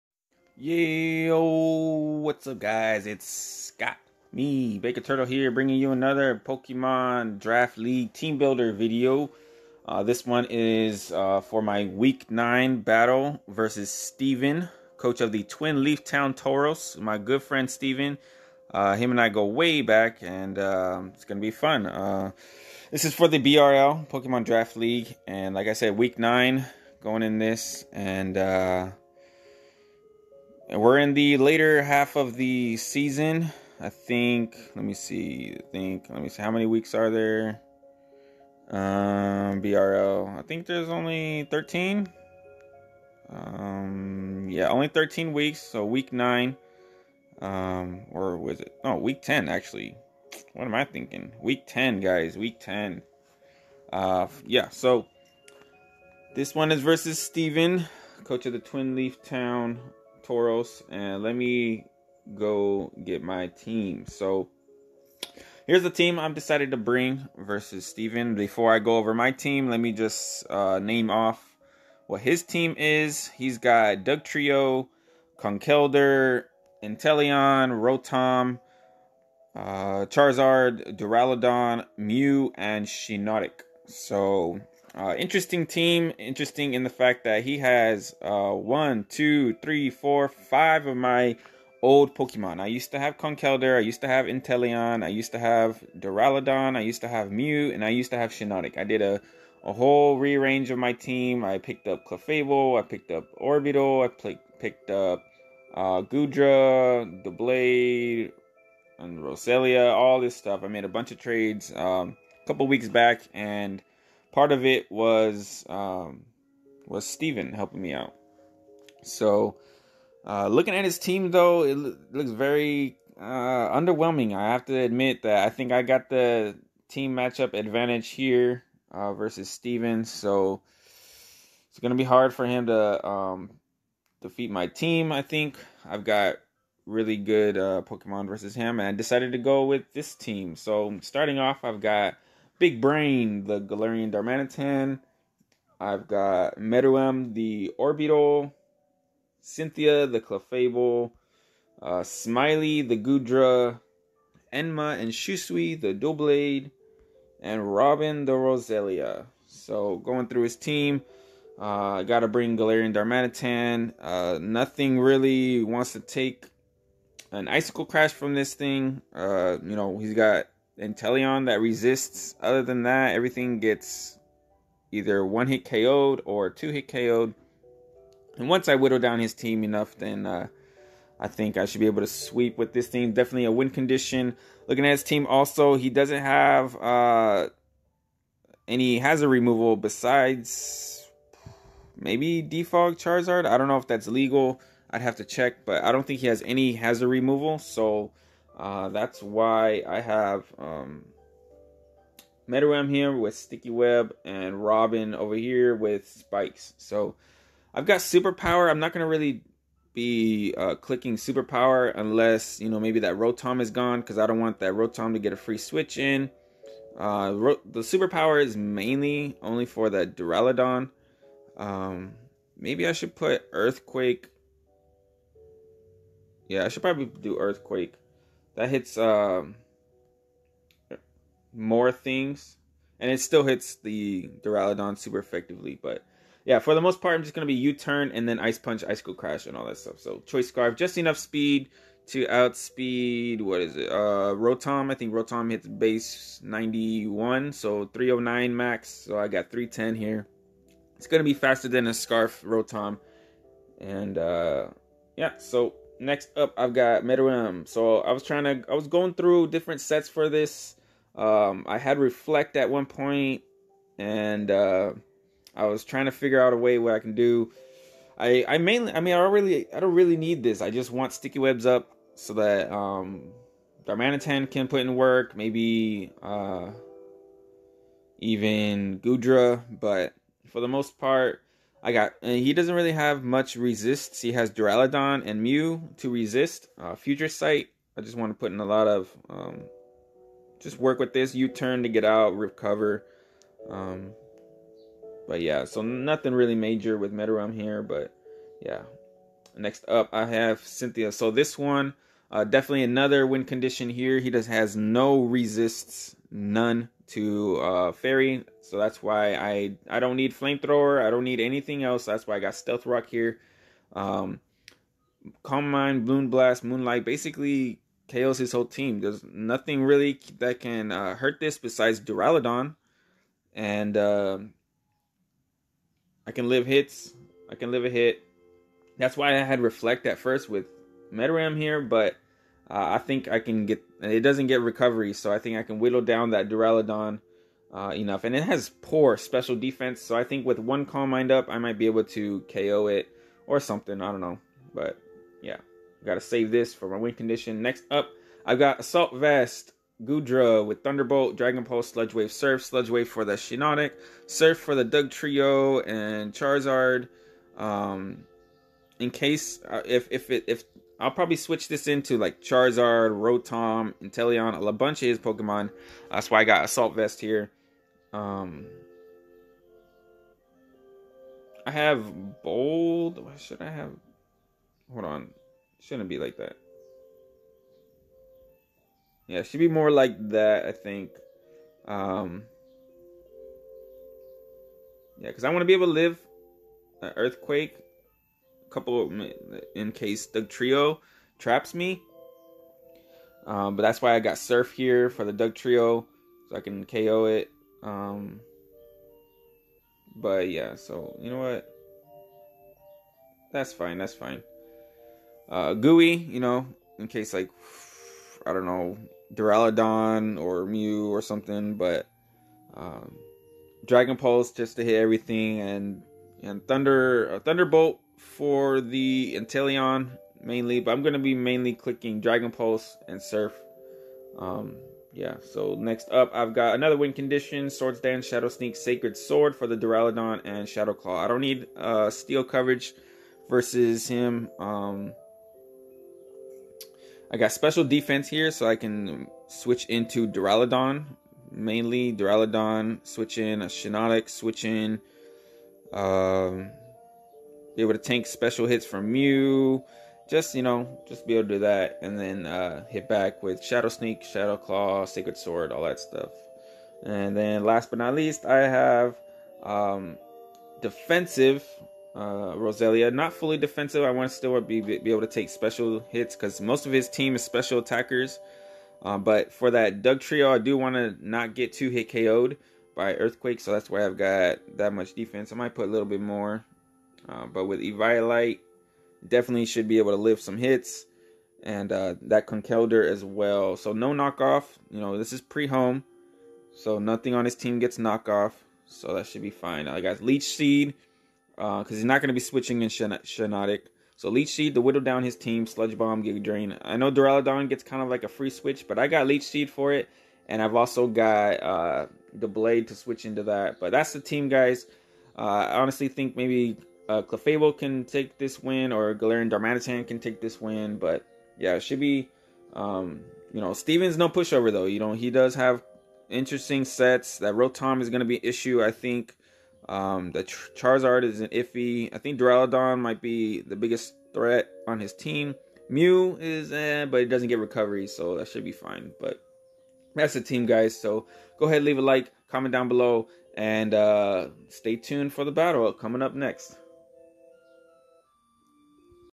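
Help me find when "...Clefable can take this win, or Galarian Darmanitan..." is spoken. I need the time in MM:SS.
08:27.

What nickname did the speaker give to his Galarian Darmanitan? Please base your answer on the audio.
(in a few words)
Big Brain.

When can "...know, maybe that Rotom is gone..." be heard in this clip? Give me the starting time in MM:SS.
03:32.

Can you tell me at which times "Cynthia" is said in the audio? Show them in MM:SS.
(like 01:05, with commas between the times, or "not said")
02:29, 05:00.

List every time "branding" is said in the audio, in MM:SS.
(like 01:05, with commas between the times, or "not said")
not said.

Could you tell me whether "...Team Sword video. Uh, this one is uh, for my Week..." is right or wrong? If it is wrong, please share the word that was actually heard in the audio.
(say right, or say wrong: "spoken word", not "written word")
wrong: "Builder", not "Sword".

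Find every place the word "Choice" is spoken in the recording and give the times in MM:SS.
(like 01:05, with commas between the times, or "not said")
04:00.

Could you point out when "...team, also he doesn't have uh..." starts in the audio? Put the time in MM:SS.
03:05.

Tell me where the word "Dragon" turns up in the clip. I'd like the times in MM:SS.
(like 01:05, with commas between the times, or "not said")
05:51, 06:53, 07:02.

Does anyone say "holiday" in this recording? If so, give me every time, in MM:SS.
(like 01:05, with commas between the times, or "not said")
not said.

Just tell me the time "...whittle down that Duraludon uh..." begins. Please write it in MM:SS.
05:35.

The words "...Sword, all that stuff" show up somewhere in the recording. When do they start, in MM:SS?
07:35.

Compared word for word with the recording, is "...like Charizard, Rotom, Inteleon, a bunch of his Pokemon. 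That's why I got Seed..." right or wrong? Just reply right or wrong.
wrong.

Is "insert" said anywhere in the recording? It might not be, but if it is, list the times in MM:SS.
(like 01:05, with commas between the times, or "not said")
not said.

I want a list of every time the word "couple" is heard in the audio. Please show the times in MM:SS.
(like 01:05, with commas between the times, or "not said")
01:52, 06:28.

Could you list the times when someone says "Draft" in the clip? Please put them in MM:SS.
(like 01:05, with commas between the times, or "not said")
00:07, 00:24.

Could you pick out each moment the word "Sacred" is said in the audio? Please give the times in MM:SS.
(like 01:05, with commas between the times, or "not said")
07:08, 07:35.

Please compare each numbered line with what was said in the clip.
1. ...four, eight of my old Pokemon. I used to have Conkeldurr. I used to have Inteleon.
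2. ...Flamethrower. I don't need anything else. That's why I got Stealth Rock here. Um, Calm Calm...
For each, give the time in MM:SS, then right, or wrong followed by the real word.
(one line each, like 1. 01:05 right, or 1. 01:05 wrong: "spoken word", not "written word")
1. 01:29 wrong: "five", not "eight"
2. 05:10 wrong: "Mind", not "Calm".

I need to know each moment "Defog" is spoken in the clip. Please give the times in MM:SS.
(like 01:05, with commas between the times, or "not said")
03:12.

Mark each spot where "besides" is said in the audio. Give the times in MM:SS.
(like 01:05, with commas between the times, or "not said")
03:09, 05:21.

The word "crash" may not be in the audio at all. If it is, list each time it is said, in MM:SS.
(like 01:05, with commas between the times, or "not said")
02:47, 03:59.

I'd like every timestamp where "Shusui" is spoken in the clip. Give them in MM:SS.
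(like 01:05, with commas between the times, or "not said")
02:35.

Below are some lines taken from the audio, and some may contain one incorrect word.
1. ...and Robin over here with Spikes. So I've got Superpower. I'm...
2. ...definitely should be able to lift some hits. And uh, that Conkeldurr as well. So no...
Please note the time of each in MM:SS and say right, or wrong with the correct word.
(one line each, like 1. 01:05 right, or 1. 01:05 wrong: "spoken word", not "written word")
1. 03:24 right
2. 07:59 right.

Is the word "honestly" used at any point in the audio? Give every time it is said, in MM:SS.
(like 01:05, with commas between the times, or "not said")
08:25.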